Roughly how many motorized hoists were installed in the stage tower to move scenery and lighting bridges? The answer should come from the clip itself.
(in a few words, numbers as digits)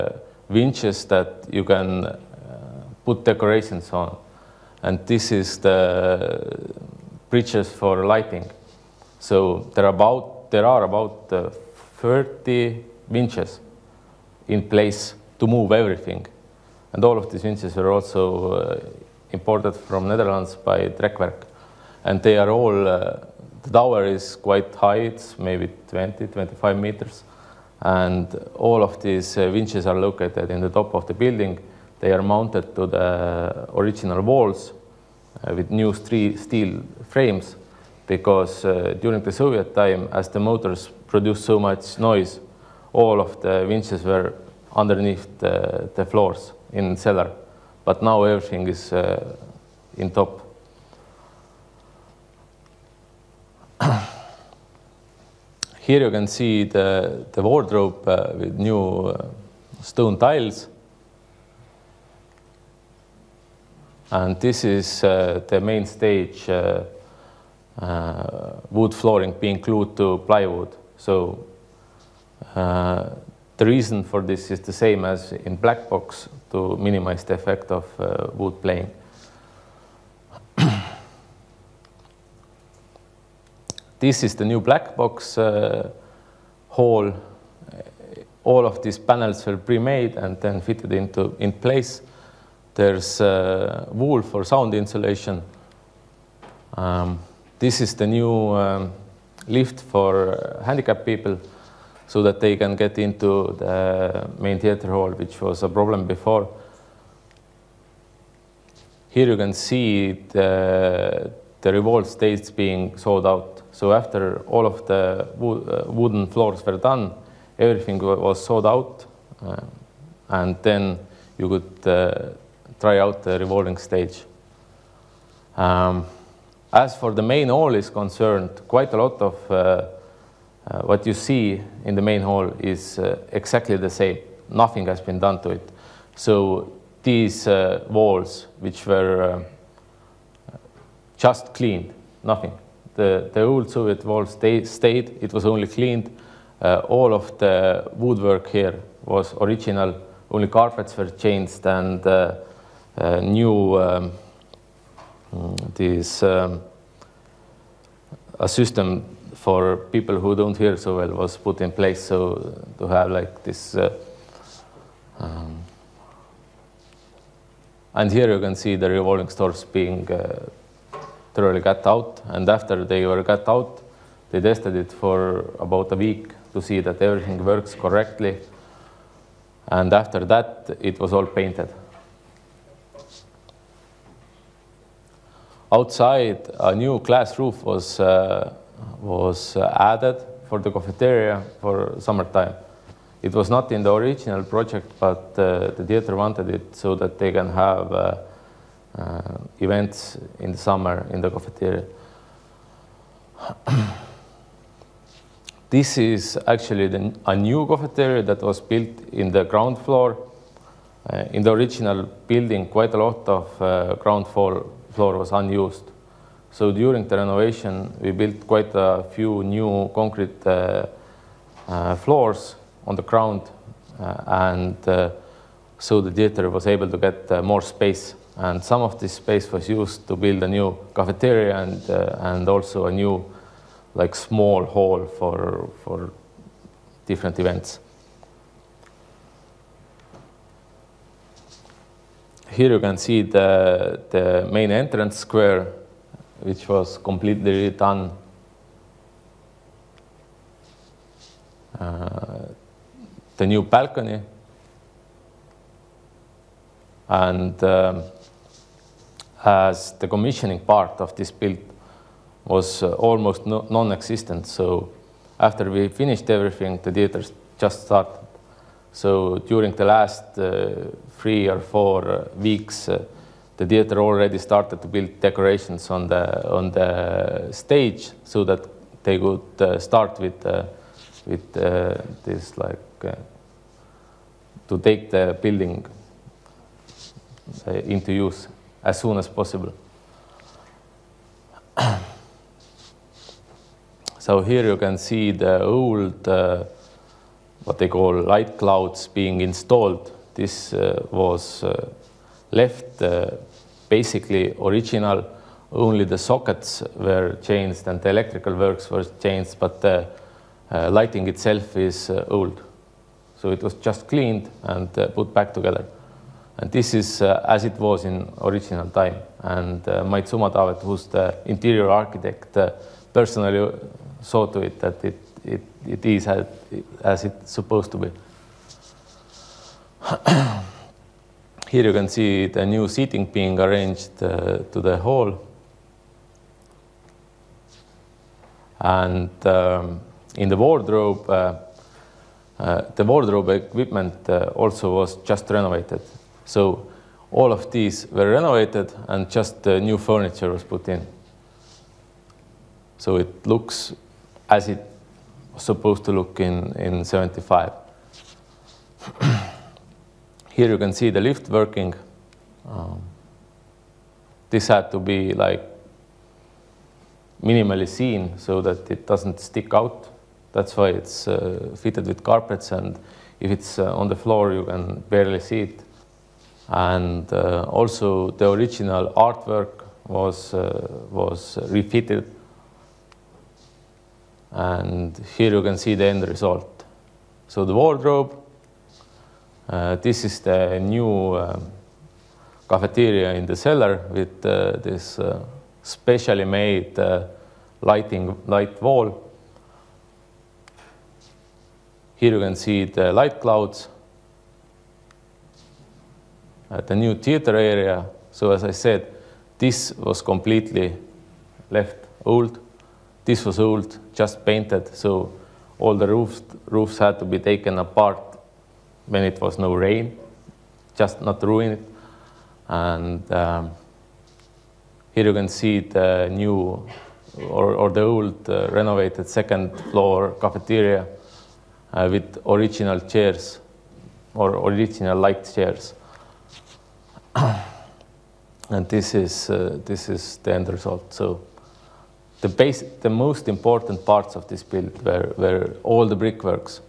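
30.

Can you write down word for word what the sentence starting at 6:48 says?
So as I said, this was completely left old.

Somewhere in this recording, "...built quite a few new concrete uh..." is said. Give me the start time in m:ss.
3:38.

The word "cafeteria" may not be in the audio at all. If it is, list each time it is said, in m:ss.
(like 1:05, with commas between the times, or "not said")
3:10, 3:21, 3:27, 3:50, 6:32, 7:10.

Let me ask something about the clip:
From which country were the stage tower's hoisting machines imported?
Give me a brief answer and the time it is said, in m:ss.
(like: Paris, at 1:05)
Netherlands, at 0:20.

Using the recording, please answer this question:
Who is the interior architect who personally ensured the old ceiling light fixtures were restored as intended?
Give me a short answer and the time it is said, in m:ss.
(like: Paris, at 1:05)
Mait Summatavet, at 5:20.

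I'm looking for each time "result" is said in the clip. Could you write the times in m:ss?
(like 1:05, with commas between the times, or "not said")
6:26, 7:20.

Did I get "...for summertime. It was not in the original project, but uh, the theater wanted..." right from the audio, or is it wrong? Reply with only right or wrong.
right.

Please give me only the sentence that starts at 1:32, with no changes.
There's uh, wool for sound insulation.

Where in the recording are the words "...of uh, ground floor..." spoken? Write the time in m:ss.
3:33.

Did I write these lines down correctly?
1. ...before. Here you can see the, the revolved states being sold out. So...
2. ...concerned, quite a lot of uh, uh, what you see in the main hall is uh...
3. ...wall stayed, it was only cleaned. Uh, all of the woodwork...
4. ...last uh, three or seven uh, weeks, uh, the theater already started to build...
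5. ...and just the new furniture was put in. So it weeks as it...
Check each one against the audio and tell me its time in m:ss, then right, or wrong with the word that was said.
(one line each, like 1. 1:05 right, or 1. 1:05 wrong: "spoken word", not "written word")
1. 1:46 right
2. 2:07 right
3. 2:24 right
4. 4:29 wrong: "four", not "seven"
5. 5:49 wrong: "looks", not "weeks".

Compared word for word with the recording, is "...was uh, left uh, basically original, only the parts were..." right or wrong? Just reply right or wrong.
wrong.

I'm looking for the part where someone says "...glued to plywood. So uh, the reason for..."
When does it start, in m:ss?
1:09.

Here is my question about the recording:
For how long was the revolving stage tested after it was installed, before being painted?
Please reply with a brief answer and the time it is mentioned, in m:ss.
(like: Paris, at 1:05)
About a week, at 2:55.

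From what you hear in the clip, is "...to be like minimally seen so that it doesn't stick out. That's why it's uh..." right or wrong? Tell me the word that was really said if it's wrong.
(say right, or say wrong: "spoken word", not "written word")
right.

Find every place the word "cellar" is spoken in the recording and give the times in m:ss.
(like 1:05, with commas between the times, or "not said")
0:46, 6:33.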